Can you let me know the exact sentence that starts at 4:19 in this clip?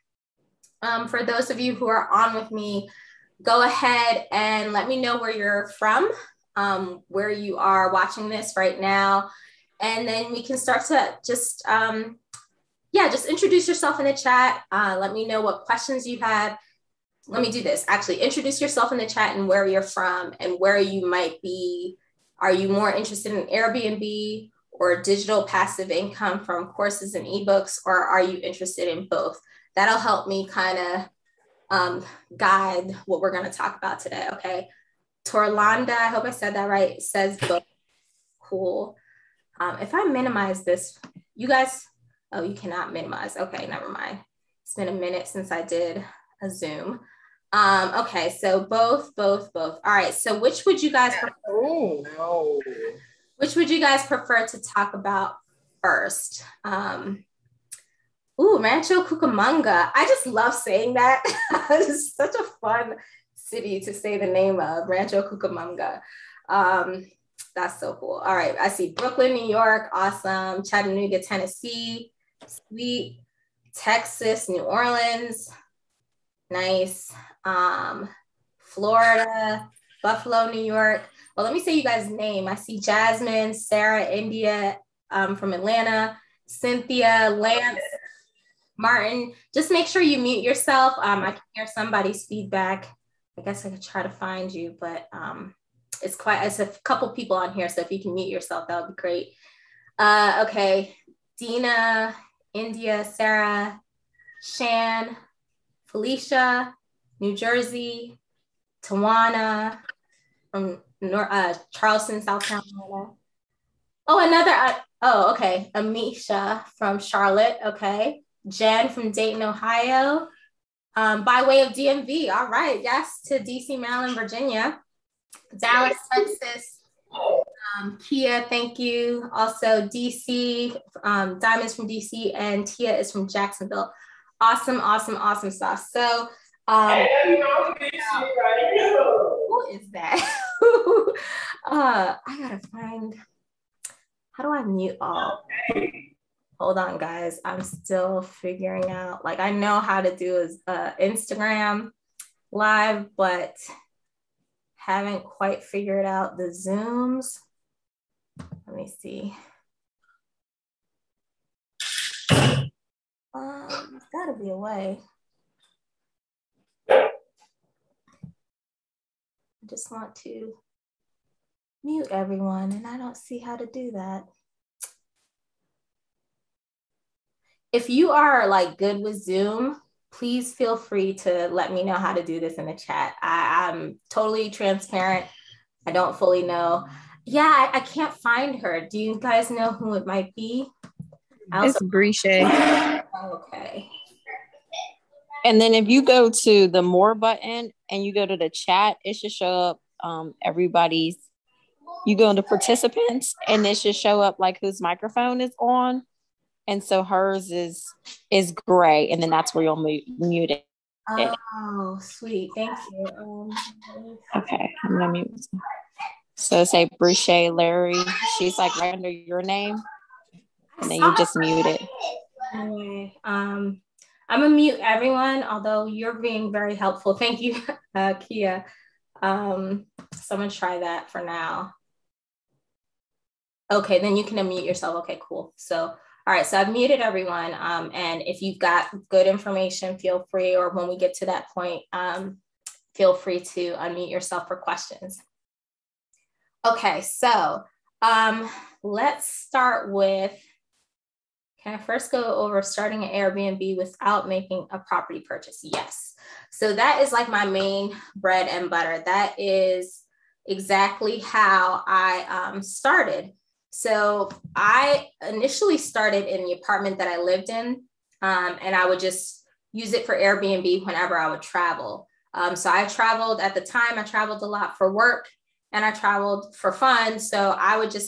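That is exactly how I um, started.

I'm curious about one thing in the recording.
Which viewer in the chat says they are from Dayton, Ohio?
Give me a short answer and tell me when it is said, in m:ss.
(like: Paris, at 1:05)
Jen, at 1:58.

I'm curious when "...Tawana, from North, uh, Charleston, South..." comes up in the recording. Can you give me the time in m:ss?
1:48.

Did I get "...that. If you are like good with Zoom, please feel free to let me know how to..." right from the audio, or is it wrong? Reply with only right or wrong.
right.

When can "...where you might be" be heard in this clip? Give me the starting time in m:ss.
0:20.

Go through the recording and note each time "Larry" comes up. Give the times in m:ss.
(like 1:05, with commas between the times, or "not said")
3:37.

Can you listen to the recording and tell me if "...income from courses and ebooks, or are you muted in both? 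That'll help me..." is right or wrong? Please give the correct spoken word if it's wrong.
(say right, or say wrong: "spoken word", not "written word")
wrong: "interested", not "muted".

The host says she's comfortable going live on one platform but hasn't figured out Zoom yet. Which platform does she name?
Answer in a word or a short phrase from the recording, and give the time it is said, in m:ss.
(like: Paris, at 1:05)
Instagram, at 2:30.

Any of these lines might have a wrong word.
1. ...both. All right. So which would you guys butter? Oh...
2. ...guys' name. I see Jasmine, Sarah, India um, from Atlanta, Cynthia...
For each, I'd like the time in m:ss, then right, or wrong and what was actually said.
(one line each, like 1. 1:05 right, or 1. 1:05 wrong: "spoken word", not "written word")
1. 0:49 wrong: "prefer", not "butter"
2. 1:21 right.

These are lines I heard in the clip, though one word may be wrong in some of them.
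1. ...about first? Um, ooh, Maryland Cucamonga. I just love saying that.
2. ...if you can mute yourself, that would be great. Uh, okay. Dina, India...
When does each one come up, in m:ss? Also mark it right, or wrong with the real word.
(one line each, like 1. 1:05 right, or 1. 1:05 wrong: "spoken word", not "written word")
1. 0:54 wrong: "Rancho", not "Maryland"
2. 1:37 right.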